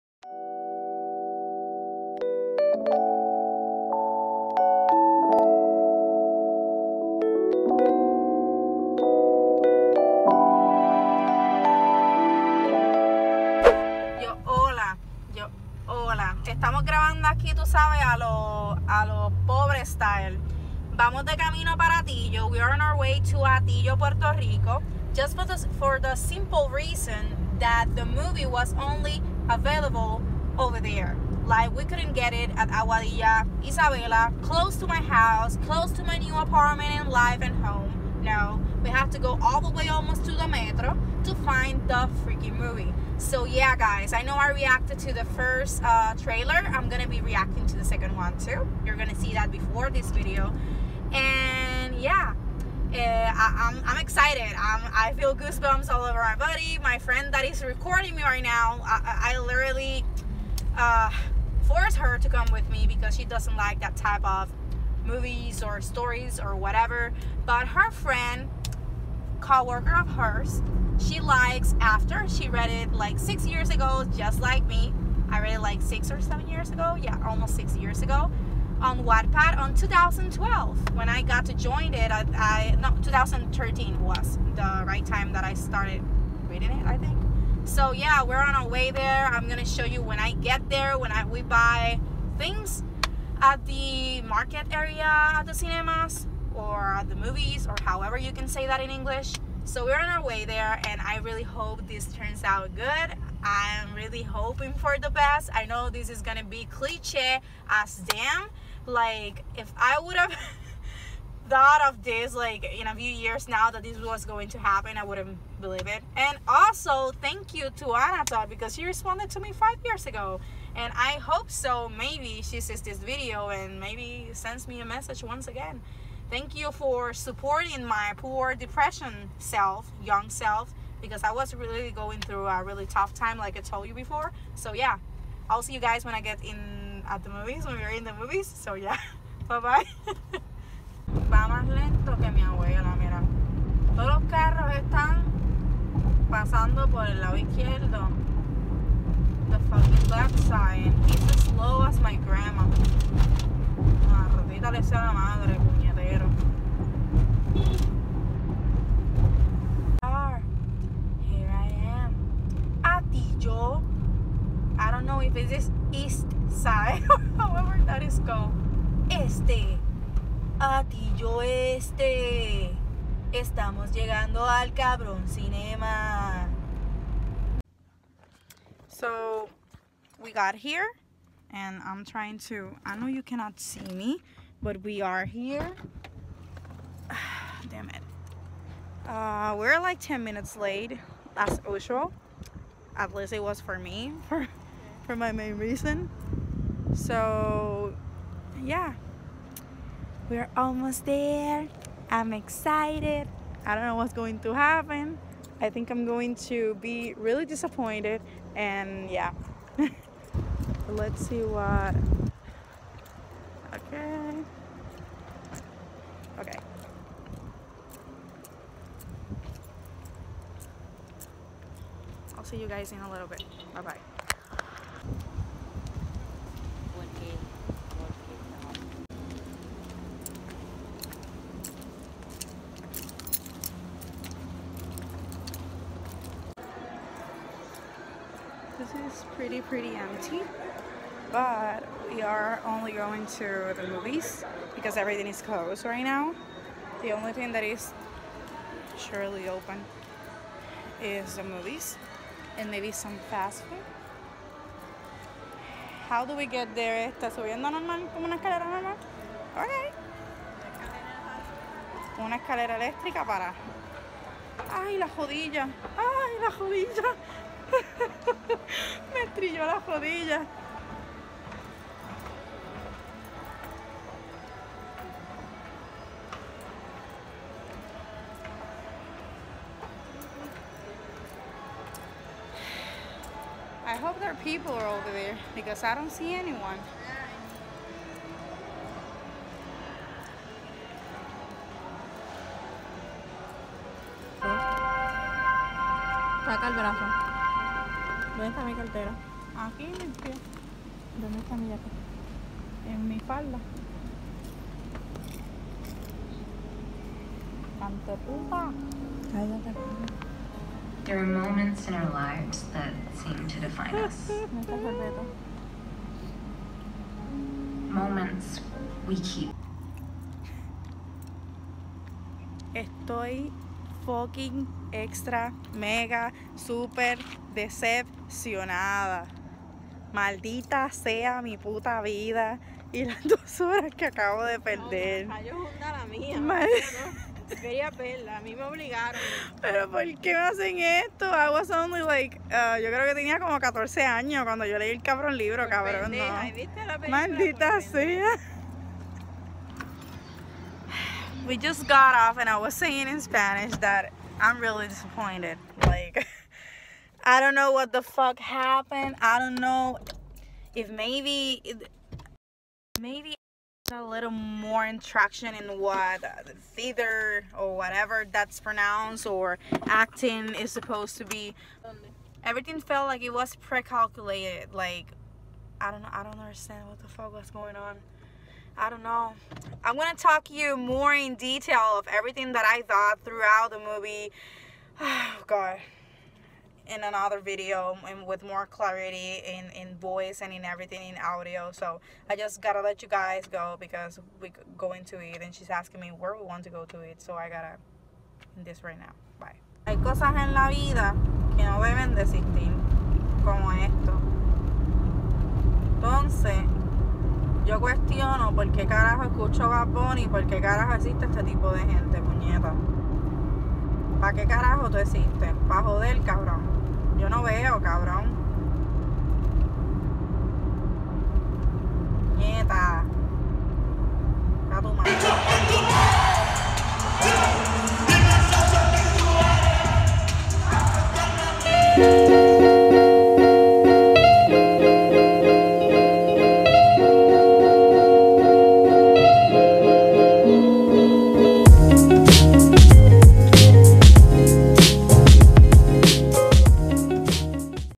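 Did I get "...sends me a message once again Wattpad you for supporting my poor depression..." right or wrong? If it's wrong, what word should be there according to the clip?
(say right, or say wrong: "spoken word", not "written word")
wrong: "Thank", not "Wattpad".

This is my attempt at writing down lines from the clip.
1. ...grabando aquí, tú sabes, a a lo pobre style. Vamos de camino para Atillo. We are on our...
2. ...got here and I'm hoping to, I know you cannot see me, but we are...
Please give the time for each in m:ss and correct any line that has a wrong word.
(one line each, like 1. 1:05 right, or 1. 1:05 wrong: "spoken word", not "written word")
1. 0:16 right
2. 3:00 wrong: "trying", not "hoping".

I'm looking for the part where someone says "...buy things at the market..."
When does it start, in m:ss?
1:31.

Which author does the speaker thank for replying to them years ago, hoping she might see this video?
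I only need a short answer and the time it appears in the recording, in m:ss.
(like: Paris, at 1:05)
Anna Todd, at 1:57.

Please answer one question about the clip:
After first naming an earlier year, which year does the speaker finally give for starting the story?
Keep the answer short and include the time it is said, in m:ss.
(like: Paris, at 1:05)
2013, at 1:23.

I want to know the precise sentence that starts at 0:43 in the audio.
So yeah, guys, I know I reacted to the first uh, trailer.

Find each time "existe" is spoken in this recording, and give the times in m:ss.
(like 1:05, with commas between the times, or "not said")
6:50, 6:54.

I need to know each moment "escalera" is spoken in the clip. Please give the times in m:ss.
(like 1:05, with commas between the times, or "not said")
4:18, 4:22.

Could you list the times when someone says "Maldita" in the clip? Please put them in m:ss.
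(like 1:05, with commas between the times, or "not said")
5:30, 5:47.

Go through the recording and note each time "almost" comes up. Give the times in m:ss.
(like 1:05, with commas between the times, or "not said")
0:39, 1:17, 3:20.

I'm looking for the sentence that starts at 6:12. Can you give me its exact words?
Everything felt like it was pre-calculated.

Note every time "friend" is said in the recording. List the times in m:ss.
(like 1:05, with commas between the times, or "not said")
0:56, 1:07.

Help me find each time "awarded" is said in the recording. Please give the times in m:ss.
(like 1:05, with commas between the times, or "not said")
not said.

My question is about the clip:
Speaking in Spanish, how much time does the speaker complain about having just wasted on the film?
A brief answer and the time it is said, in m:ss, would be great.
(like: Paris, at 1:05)
2 hours, at 5:33.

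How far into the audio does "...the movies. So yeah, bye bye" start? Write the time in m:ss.
2:18.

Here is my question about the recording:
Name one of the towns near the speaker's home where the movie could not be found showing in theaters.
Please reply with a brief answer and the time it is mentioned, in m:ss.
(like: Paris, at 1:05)
Aguadilla, at 0:32.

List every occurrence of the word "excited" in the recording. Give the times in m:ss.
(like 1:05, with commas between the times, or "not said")
0:53, 3:22.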